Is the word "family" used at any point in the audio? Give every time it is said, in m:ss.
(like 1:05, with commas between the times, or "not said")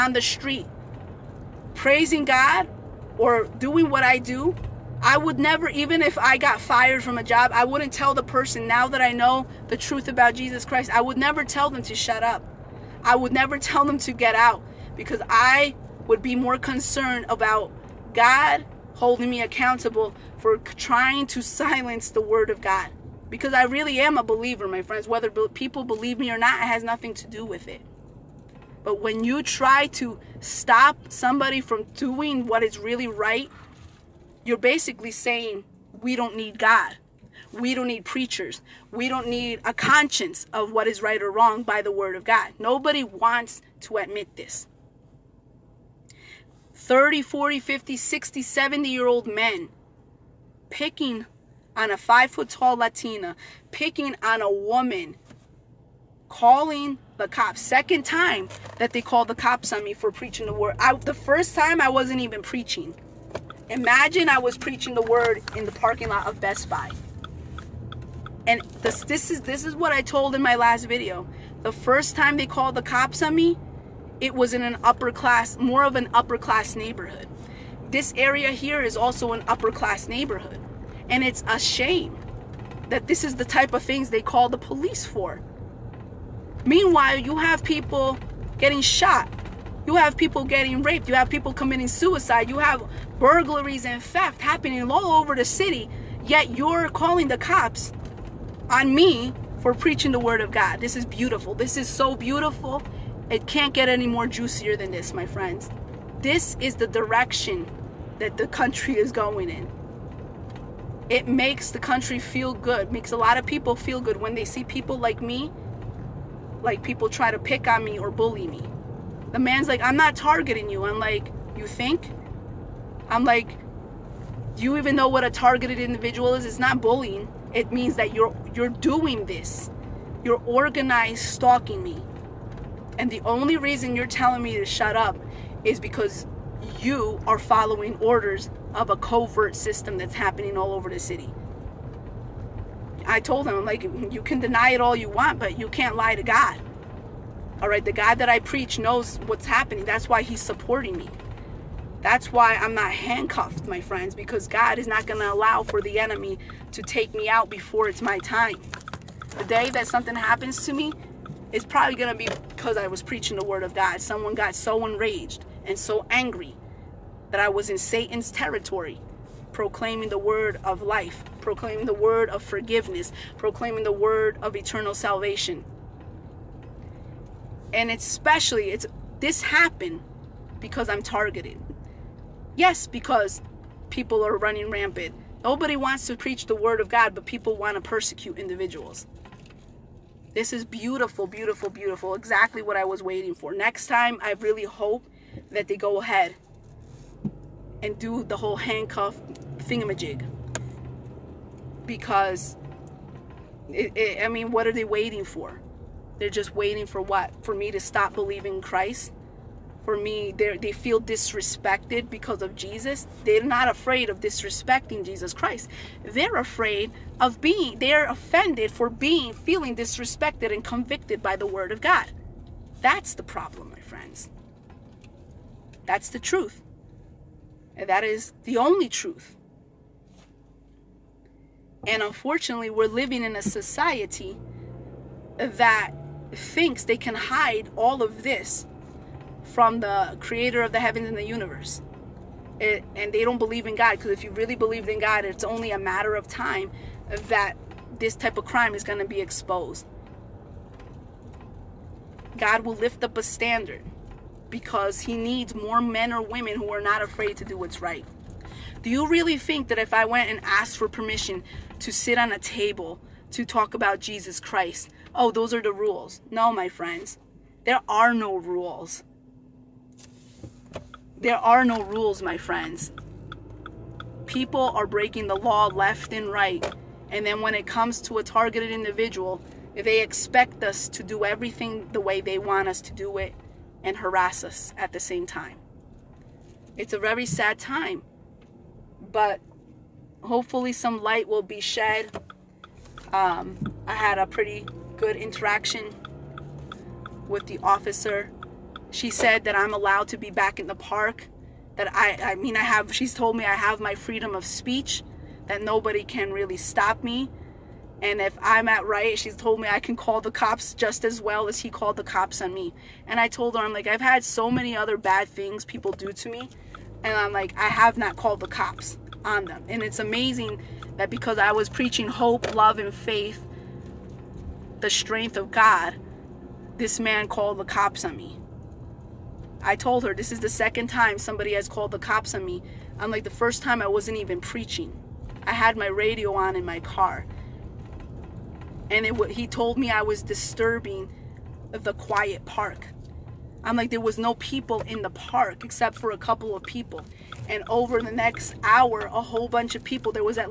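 not said.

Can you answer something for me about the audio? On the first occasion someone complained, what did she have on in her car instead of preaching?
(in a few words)
Radio.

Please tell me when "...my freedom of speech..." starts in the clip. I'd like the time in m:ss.
5:03.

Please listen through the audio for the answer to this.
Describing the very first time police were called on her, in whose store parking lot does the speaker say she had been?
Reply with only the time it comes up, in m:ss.
1:06.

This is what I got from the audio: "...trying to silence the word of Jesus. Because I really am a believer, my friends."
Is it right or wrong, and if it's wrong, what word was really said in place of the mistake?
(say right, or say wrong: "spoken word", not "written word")
wrong: "God", not "Jesus".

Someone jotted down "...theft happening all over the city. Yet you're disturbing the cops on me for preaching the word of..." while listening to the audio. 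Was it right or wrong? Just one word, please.
wrong.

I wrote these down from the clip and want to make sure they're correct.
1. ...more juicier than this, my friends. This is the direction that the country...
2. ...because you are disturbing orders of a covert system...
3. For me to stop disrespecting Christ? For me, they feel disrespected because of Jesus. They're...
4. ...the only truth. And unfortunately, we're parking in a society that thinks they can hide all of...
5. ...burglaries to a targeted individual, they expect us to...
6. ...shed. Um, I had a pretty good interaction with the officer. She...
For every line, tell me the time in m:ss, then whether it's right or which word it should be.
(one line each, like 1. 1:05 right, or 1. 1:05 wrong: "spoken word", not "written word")
1. 1:44 right
2. 2:15 wrong: "following", not "disturbing"
3. 3:27 wrong: "believing", not "disrespecting"
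4. 3:48 wrong: "living", not "parking"
5. 4:37 wrong: "comes", not "burglaries"
6. 4:51 right.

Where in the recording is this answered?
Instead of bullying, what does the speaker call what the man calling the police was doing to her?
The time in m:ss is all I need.
2:10.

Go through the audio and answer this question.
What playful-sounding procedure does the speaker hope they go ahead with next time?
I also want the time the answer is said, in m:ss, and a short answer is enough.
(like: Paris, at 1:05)
Handcuff thingamajig, at 3:18.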